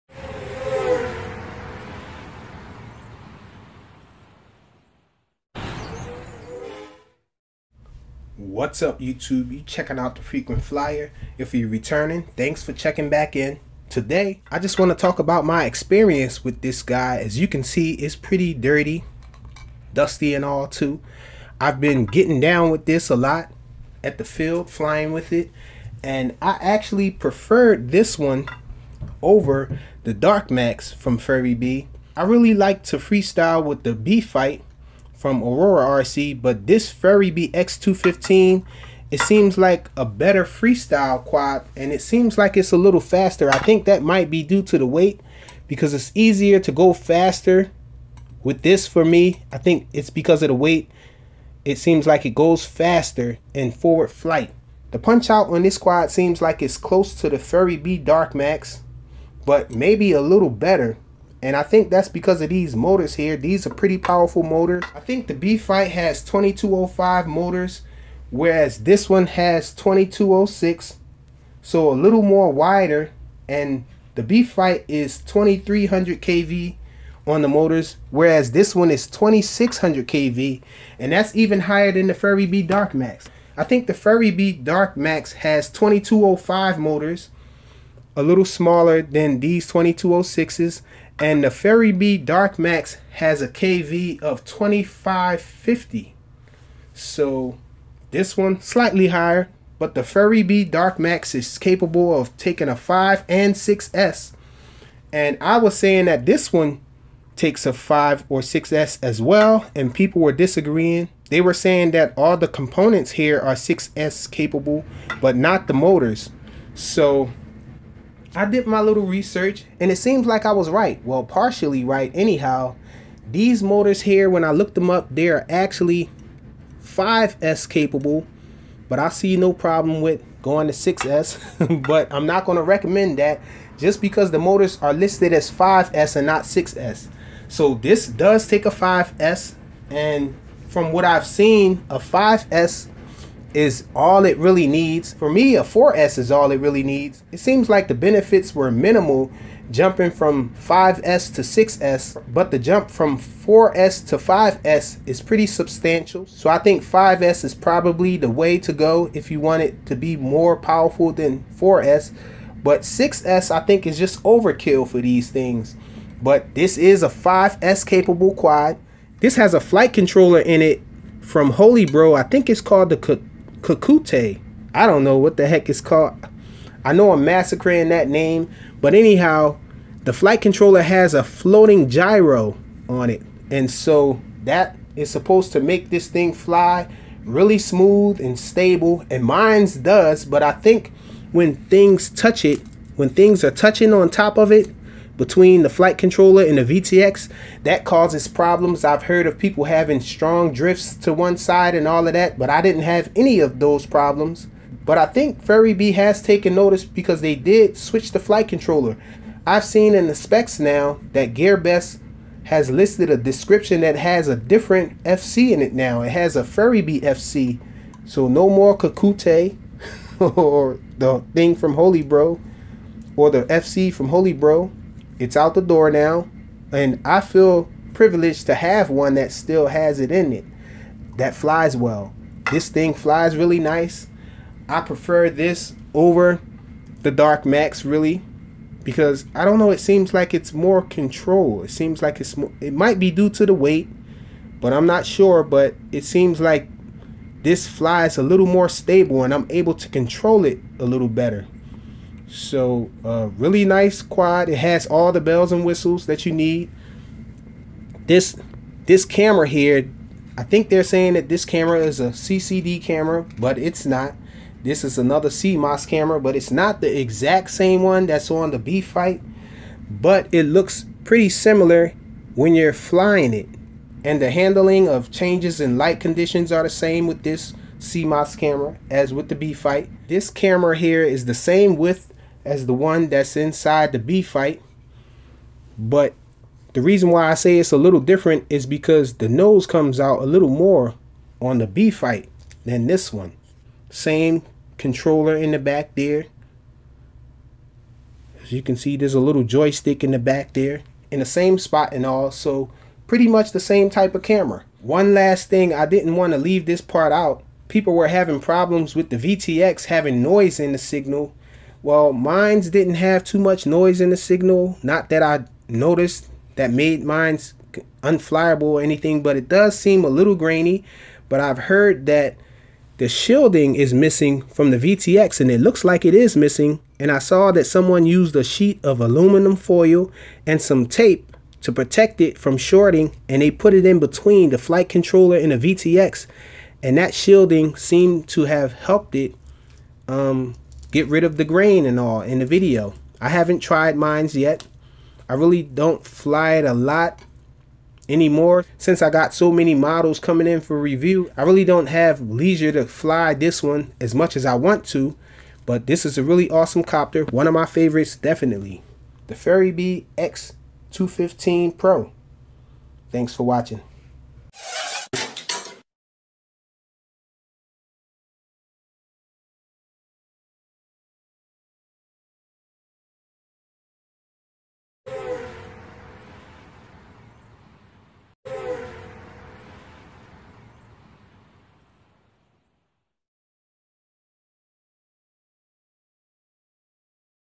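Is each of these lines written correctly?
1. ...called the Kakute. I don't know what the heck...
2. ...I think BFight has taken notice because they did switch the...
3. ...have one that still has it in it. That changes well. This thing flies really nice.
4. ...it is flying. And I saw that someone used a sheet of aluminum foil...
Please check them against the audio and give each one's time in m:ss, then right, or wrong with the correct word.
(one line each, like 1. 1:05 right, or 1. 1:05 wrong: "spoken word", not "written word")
1. 2:52 right
2. 3:24 wrong: "Furibee", not "BFight"
3. 3:48 wrong: "flies", not "changes"
4. 5:26 wrong: "missing", not "flying".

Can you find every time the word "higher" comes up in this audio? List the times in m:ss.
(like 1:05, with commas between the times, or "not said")
1:21, 1:39.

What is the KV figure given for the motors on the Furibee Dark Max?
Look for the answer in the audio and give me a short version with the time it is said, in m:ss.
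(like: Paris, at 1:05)
2550, at 1:34.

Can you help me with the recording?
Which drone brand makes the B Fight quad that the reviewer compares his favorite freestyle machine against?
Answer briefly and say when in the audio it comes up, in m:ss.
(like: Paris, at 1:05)
Aurora RC, at 0:35.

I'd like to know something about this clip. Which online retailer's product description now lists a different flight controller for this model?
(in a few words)
GearBest.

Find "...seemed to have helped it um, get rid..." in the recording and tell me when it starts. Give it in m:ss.
5:37.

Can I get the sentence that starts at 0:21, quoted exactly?
I've been getting down with this a lot at the field, flying with it.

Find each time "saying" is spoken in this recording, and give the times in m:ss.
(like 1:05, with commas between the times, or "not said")
1:45, 1:51, 4:20.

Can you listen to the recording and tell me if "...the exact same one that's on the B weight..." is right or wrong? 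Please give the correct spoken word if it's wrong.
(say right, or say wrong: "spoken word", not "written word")
wrong: "fight", not "weight".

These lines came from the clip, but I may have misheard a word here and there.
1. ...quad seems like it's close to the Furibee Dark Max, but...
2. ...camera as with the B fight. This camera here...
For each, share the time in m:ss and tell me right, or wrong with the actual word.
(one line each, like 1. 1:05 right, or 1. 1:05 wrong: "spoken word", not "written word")
1. 0:55 right
2. 4:38 right.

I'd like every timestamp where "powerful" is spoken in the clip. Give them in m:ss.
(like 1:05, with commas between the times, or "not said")
1:03, 2:40.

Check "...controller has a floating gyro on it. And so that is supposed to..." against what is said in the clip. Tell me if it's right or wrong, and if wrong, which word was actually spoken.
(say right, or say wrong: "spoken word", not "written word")
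right.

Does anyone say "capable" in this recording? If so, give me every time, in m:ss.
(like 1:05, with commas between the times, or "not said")
1:41, 1:54, 2:07, 2:47.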